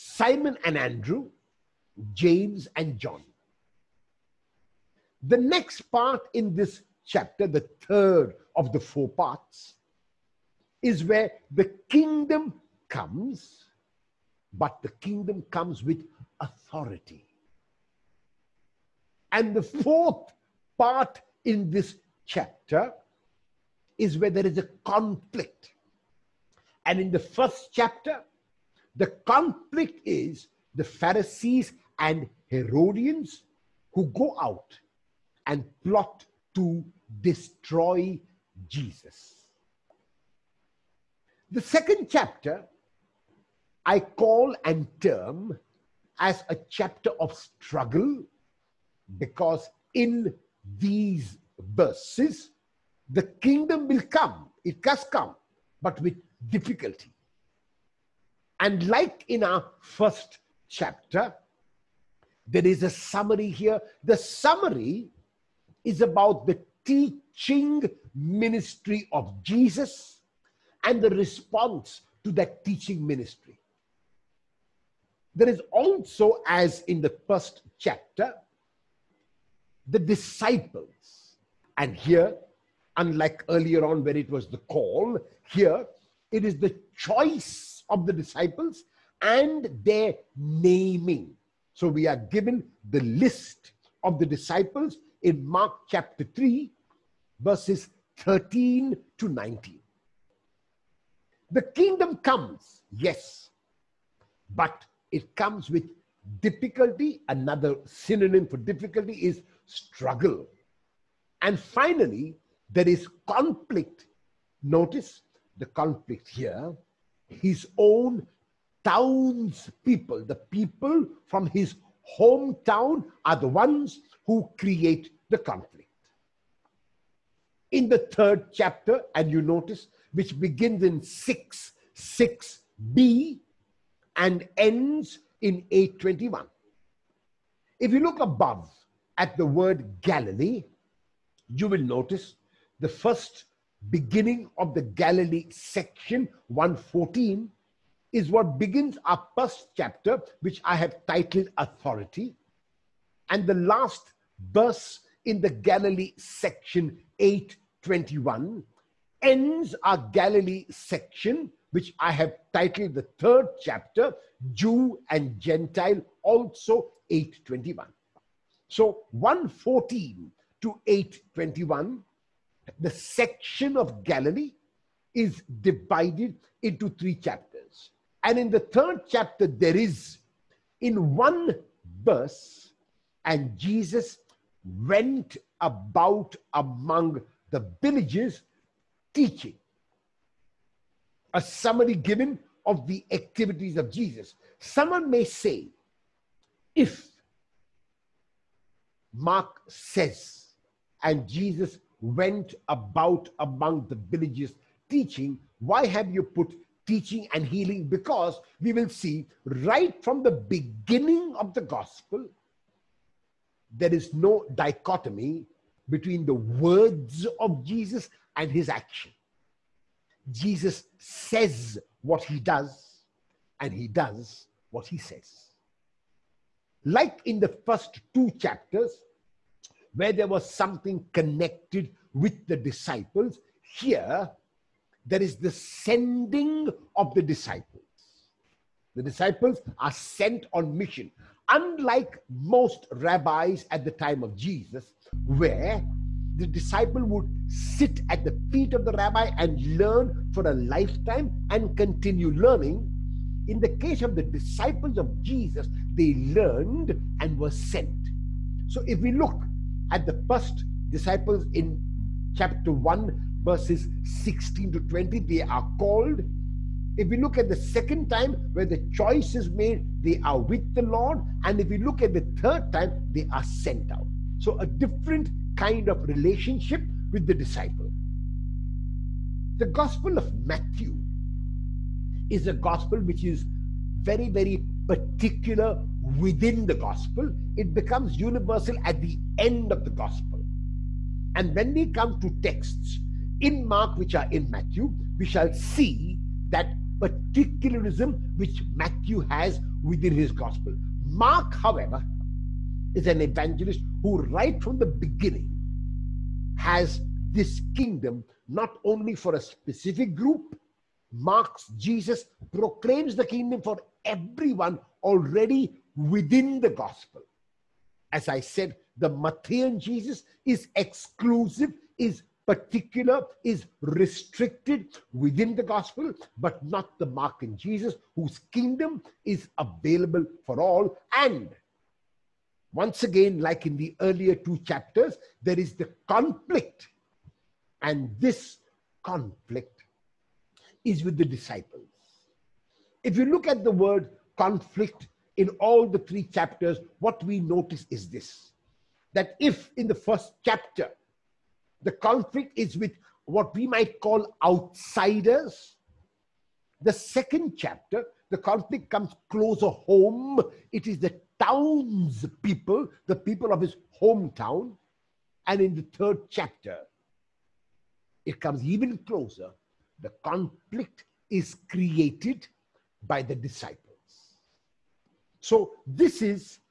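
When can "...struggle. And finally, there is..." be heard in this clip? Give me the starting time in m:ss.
1:49.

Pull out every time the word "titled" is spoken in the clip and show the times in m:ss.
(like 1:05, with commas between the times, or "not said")
2:31, 2:42.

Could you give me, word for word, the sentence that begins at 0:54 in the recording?
It has come, but with difficulty.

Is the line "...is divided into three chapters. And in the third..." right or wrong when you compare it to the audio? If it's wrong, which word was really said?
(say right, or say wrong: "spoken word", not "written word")
right.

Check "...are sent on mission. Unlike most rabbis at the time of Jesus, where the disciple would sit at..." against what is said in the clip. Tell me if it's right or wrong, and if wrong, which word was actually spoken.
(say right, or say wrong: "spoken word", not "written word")
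right.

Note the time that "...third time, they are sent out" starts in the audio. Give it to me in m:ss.
4:32.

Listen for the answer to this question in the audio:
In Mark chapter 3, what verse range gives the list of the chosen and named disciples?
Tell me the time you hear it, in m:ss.
1:37.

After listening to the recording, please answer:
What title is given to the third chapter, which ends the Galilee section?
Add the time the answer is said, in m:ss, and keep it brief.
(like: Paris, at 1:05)
Jew and Gentile, at 2:44.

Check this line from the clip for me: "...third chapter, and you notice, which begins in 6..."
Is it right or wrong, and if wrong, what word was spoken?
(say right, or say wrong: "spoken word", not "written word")
right.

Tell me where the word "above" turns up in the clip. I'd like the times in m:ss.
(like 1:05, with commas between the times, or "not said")
2:18.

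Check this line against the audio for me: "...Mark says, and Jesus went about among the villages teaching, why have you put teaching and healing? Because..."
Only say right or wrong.
right.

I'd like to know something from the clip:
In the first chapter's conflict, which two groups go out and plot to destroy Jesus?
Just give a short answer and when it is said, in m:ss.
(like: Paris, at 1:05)
Pharisees and Herodians, at 0:30.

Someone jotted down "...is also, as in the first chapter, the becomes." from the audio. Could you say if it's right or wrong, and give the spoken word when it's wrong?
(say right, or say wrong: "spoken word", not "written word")
wrong: "disciples", not "becomes".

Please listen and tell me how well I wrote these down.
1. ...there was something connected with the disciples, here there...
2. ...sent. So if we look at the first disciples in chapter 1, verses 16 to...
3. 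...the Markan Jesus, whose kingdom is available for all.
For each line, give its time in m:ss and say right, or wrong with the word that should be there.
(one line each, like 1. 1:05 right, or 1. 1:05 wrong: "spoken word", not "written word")
1. 3:50 right
2. 4:17 right
3. 5:26 right.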